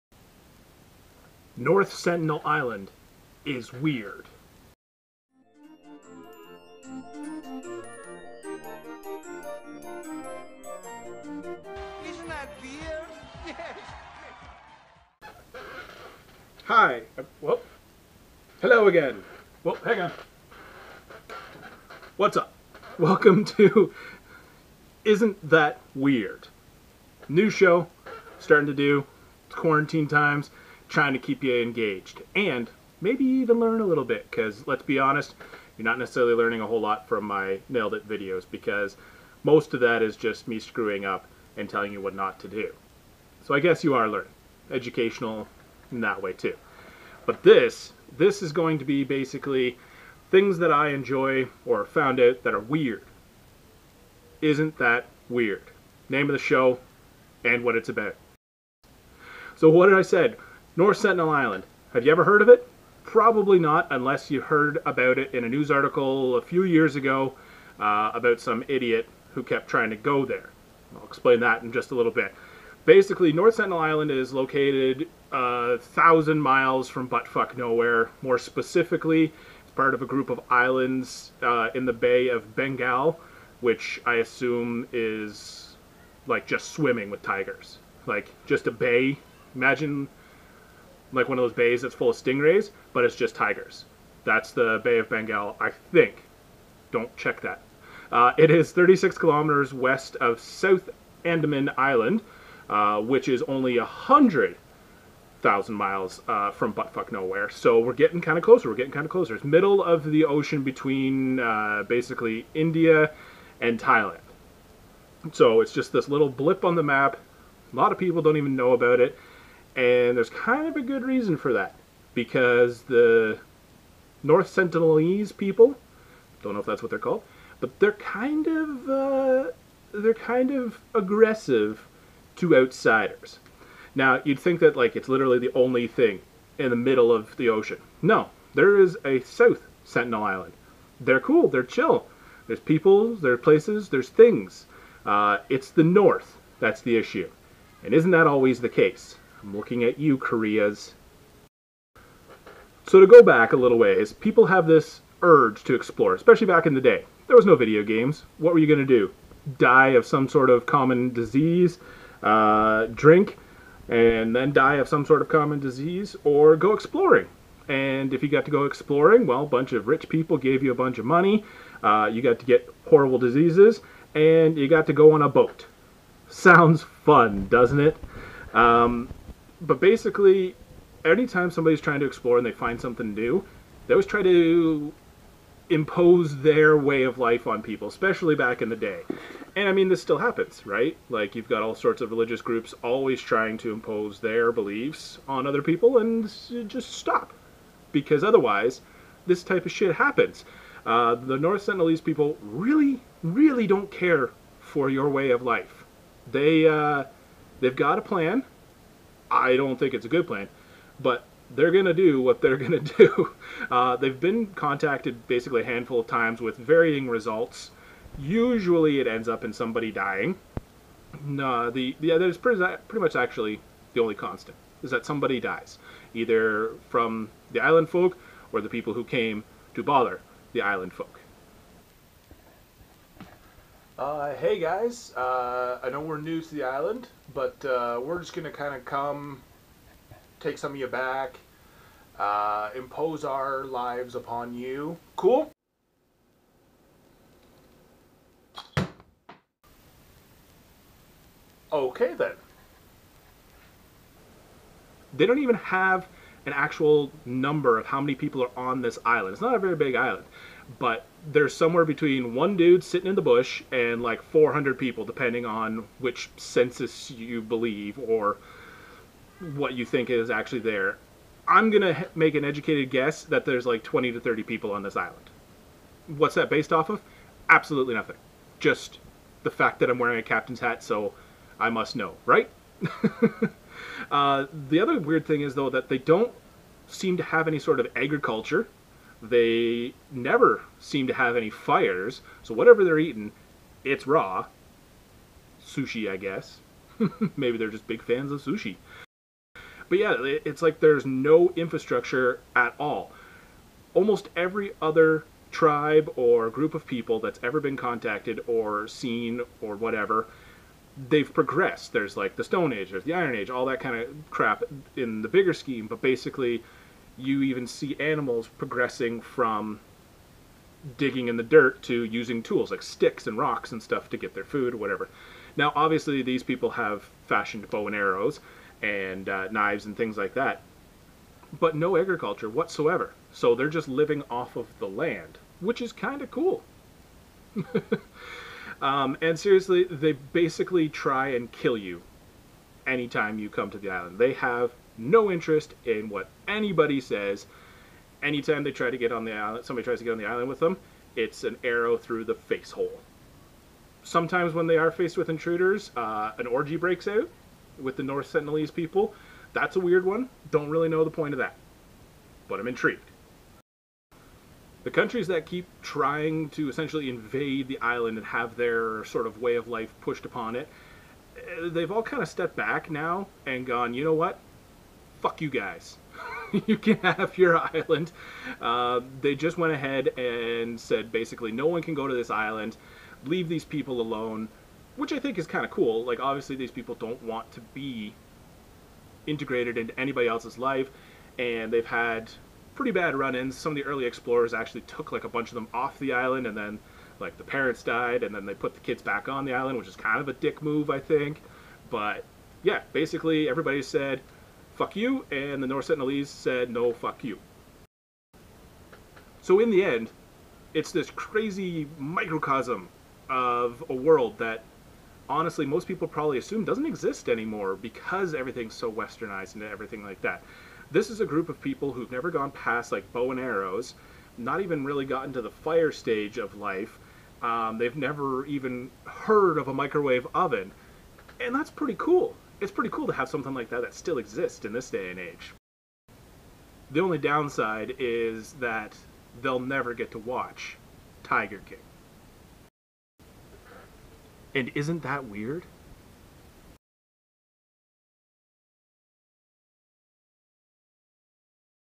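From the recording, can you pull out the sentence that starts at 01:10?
I'll explain that in just a little bit.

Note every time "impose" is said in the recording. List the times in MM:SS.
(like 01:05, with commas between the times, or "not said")
03:05, 03:13, 04:02.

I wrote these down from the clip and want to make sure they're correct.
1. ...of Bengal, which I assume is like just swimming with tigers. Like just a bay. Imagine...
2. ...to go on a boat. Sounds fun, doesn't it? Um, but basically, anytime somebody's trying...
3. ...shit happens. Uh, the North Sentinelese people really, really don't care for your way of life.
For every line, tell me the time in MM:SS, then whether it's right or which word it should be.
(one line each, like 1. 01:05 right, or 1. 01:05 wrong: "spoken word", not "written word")
1. 01:22 right
2. 02:54 right
3. 03:19 right.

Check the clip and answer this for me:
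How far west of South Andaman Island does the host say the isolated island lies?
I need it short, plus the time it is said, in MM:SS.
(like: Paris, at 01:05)
36 kilometers, at 01:38.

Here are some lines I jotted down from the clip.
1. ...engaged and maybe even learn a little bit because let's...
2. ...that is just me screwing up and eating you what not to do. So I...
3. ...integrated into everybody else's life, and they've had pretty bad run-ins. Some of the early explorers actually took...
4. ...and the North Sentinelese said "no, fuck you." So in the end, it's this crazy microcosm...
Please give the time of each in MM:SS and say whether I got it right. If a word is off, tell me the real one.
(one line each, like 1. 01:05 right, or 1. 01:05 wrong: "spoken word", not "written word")
1. 00:31 right
2. 00:39 wrong: "telling", not "eating"
3. 06:29 wrong: "anybody", not "everybody"
4. 06:45 right.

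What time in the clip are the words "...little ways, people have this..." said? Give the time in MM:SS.
02:33.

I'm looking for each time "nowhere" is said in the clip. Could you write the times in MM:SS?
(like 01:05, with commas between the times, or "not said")
01:17, 01:47.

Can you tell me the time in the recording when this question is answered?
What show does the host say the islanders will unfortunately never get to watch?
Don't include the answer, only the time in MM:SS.
07:21.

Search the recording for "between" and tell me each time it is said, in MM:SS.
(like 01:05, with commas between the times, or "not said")
01:50, 04:21.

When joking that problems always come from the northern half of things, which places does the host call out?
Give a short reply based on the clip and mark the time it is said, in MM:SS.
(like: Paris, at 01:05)
Koreas, at 02:30.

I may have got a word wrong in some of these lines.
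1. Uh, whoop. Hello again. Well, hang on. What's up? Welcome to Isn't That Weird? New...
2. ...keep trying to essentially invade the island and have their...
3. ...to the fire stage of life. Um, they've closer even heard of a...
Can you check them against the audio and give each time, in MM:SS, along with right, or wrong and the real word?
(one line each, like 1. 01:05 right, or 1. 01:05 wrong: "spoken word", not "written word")
1. 00:17 right
2. 06:05 right
3. 07:05 wrong: "never", not "closer".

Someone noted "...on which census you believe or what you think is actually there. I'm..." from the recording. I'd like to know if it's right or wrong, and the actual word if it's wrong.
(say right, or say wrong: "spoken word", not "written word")
right.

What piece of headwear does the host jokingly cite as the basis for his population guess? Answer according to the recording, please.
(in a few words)
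captain's hat.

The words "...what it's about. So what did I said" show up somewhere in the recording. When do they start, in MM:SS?
00:57.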